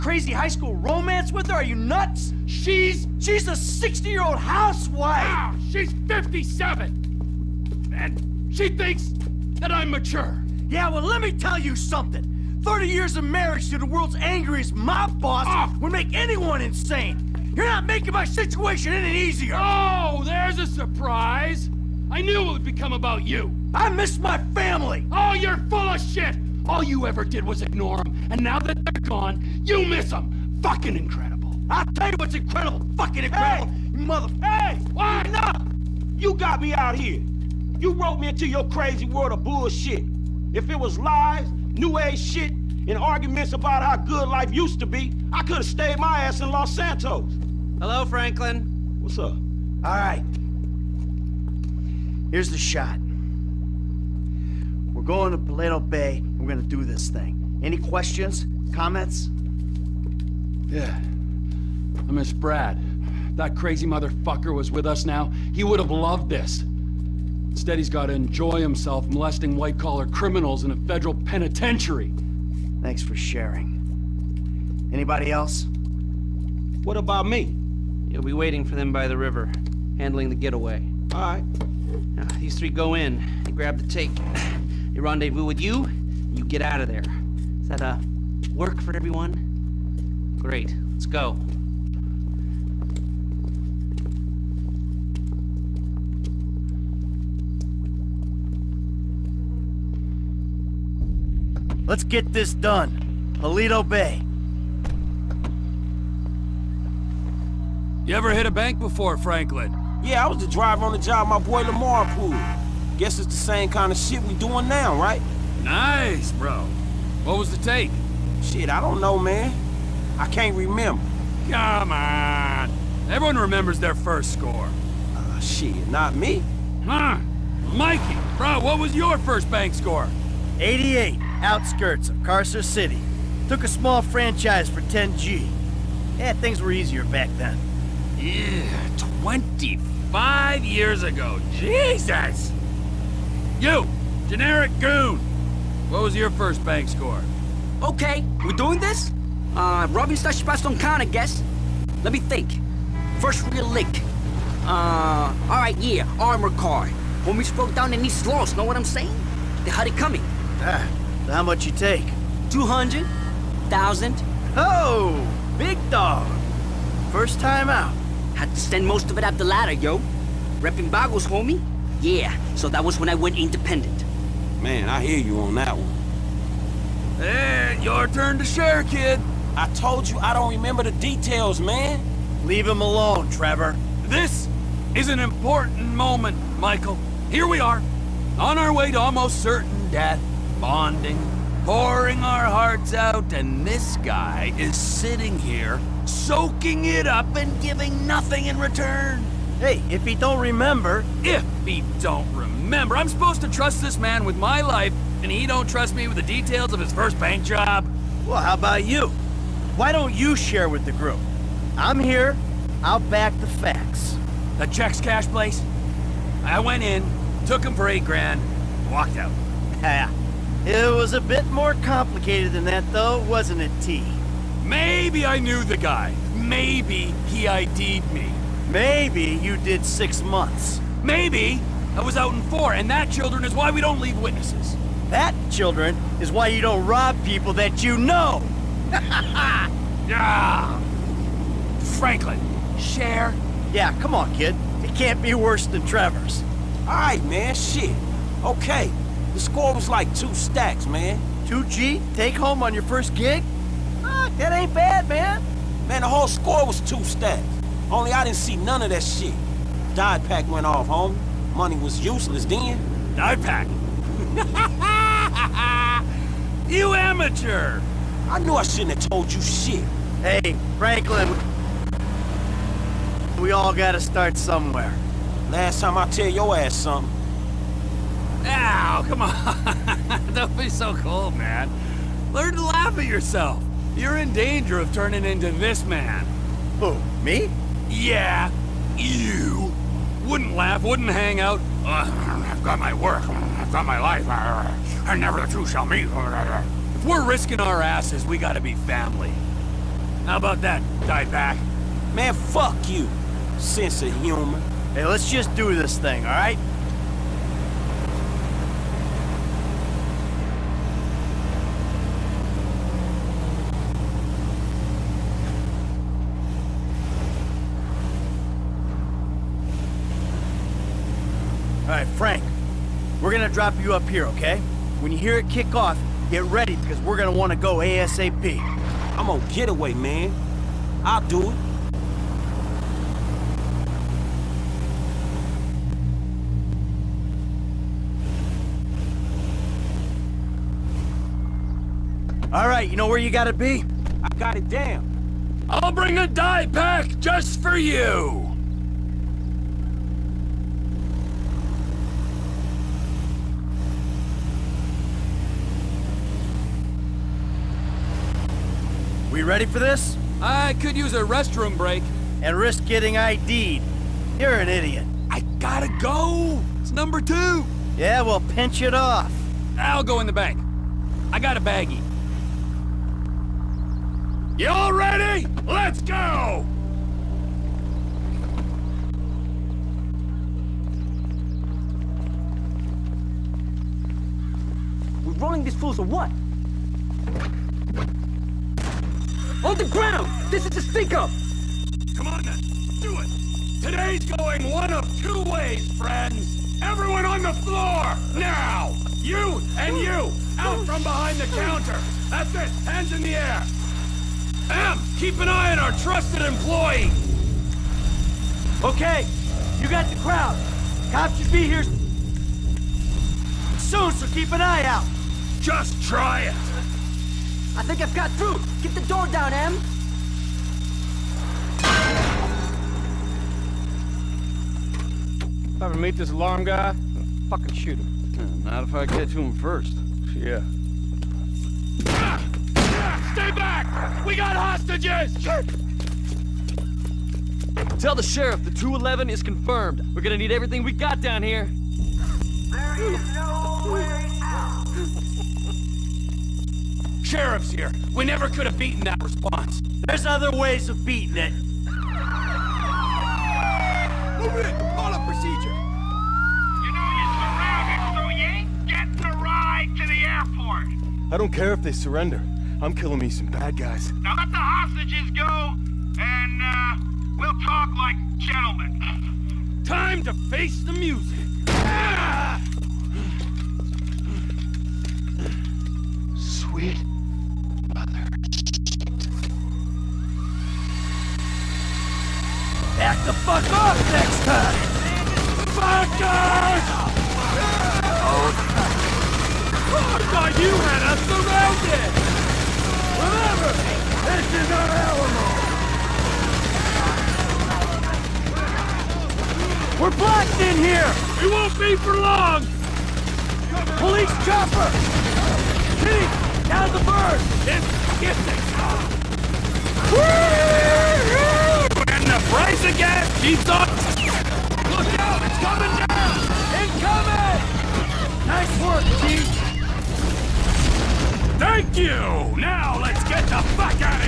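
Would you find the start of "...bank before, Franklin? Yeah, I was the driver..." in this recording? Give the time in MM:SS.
01:48.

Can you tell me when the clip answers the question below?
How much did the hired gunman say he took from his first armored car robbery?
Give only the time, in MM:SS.
02:42.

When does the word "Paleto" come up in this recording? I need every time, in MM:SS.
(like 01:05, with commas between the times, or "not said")
00:55, 01:43.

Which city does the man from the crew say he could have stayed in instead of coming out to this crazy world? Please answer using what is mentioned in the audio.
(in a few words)
Los Santos.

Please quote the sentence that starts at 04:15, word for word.
Man, the whole score was two stacks.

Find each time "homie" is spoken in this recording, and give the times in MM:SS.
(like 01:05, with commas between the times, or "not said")
02:37, 02:51, 04:20.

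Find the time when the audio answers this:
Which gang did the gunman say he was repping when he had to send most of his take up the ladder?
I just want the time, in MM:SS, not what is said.
02:50.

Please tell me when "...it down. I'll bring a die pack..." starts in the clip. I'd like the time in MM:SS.
05:44.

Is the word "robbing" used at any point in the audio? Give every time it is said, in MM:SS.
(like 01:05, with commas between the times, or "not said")
02:29.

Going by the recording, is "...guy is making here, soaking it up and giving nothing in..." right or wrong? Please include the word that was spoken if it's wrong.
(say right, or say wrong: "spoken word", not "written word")
wrong: "sitting", not "making".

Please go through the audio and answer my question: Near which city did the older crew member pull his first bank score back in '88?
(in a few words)
Carcer City.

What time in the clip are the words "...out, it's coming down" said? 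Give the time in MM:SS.
08:35.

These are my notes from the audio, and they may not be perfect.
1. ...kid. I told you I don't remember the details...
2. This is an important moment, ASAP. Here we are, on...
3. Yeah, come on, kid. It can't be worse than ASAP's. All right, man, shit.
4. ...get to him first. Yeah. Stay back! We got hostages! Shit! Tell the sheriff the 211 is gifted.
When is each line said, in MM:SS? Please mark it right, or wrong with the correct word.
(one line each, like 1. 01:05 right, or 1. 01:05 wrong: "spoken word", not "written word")
1. 02:58 right
2. 03:04 wrong: "Michael", not "ASAP"
3. 04:03 wrong: "Trevor", not "ASAP"
4. 07:09 wrong: "confirmed", not "gifted".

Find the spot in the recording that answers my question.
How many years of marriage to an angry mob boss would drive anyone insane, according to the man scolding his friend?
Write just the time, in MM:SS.
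00:12.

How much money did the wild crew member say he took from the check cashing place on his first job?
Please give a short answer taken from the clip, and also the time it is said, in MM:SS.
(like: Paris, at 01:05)
8 grand, at 03:37.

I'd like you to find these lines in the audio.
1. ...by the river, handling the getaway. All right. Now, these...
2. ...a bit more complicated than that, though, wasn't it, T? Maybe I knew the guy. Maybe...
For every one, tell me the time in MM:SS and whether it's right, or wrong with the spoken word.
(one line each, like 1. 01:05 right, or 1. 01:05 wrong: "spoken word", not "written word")
1. 01:18 right
2. 03:41 right.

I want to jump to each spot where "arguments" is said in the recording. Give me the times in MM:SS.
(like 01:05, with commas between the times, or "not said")
00:42.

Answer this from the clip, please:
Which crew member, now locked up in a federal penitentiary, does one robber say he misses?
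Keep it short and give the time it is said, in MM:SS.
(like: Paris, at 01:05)
Brad, at 01:02.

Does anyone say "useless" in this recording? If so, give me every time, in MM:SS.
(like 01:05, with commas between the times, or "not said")
04:22.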